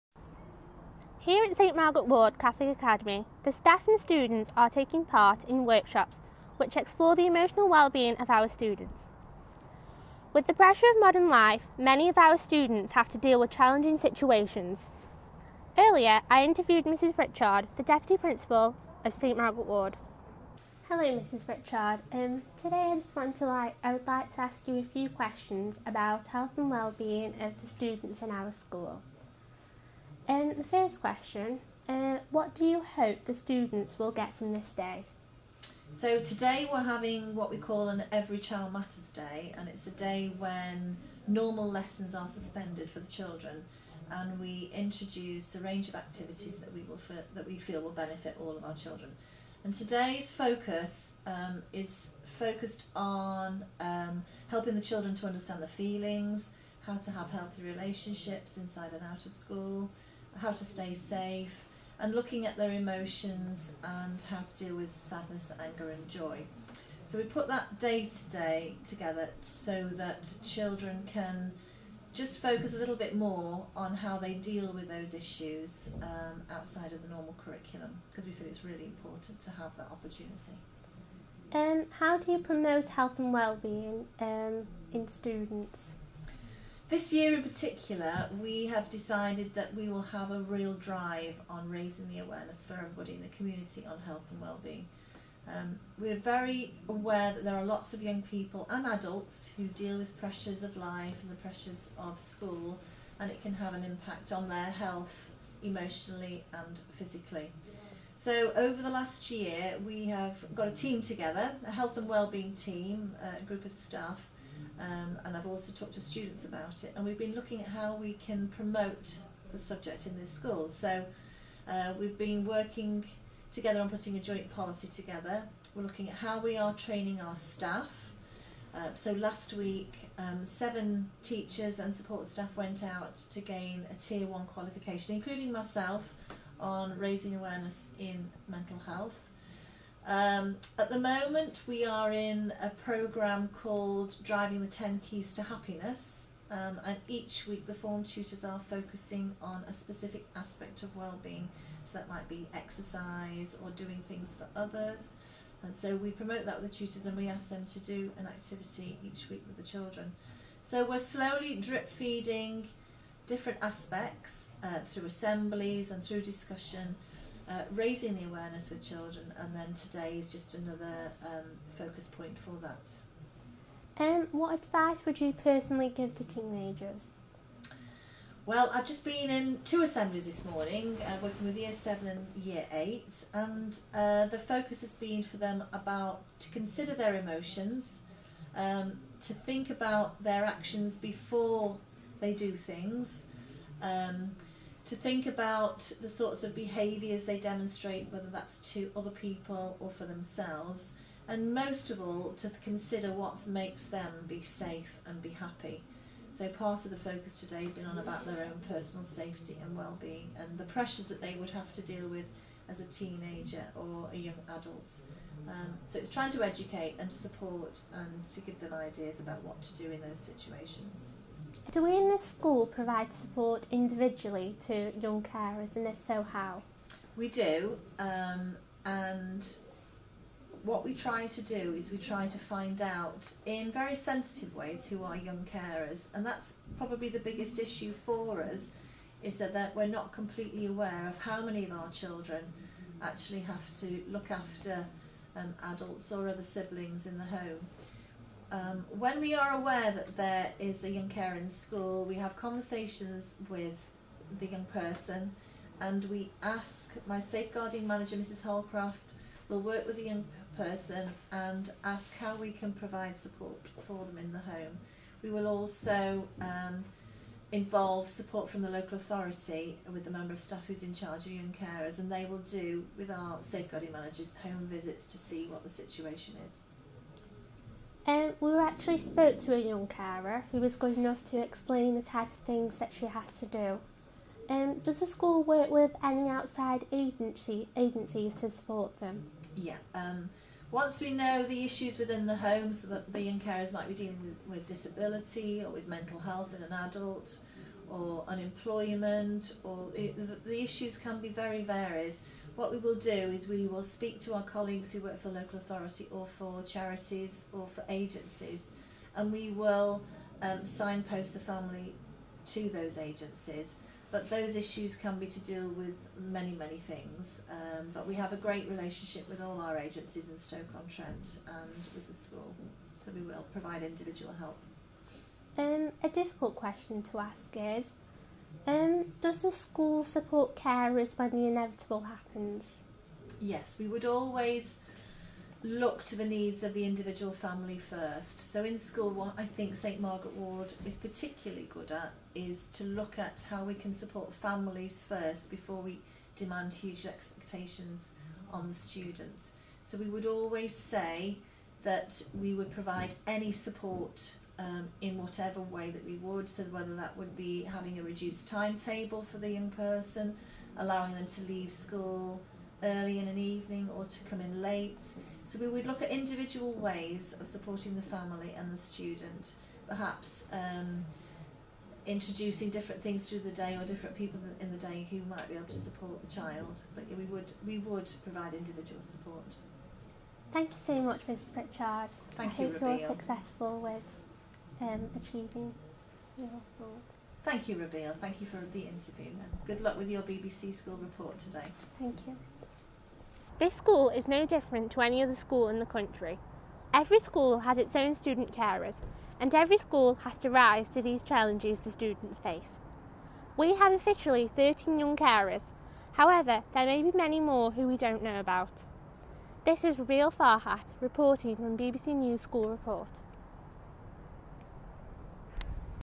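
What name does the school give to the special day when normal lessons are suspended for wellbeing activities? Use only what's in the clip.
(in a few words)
Every Child Matters Day.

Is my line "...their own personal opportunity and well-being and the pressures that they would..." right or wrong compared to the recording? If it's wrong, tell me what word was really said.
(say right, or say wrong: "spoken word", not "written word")
wrong: "safety", not "opportunity".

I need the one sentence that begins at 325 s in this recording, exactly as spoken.
Um, a difficult question to ask is um, does the school support carers when the inevitable happens?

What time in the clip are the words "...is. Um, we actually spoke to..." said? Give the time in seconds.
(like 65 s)
276 s.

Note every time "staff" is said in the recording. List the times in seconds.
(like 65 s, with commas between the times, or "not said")
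3 s, 113 s, 127 s, 132 s, 270 s.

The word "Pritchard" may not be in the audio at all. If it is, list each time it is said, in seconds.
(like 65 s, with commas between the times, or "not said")
17 s, 21 s, 381 s.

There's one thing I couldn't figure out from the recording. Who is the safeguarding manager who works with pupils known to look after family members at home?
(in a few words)
Mrs Holcroft.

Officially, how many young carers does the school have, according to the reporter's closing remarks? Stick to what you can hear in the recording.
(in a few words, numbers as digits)
13.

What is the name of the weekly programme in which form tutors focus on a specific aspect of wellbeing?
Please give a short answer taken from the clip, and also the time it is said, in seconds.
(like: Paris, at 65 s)
Driving the 10 Keys to Happiness, at 144 s.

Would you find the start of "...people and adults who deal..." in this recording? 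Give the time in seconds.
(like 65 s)
98 s.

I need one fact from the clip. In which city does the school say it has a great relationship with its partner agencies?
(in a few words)
Stoke-on-Trent.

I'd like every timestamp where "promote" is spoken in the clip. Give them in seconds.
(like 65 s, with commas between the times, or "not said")
82 s, 118 s, 156 s.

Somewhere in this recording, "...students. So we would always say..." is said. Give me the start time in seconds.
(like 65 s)
348 s.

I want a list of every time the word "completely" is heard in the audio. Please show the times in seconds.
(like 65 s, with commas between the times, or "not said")
240 s.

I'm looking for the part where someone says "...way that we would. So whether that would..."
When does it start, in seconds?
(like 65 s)
355 s.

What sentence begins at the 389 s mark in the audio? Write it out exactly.
good luck with your BBC school report today.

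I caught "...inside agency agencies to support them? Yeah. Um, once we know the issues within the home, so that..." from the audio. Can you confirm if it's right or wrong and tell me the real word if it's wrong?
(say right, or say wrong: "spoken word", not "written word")
wrong: "outside", not "inside".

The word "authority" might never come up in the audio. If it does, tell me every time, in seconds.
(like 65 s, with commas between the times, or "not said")
268 s, 305 s.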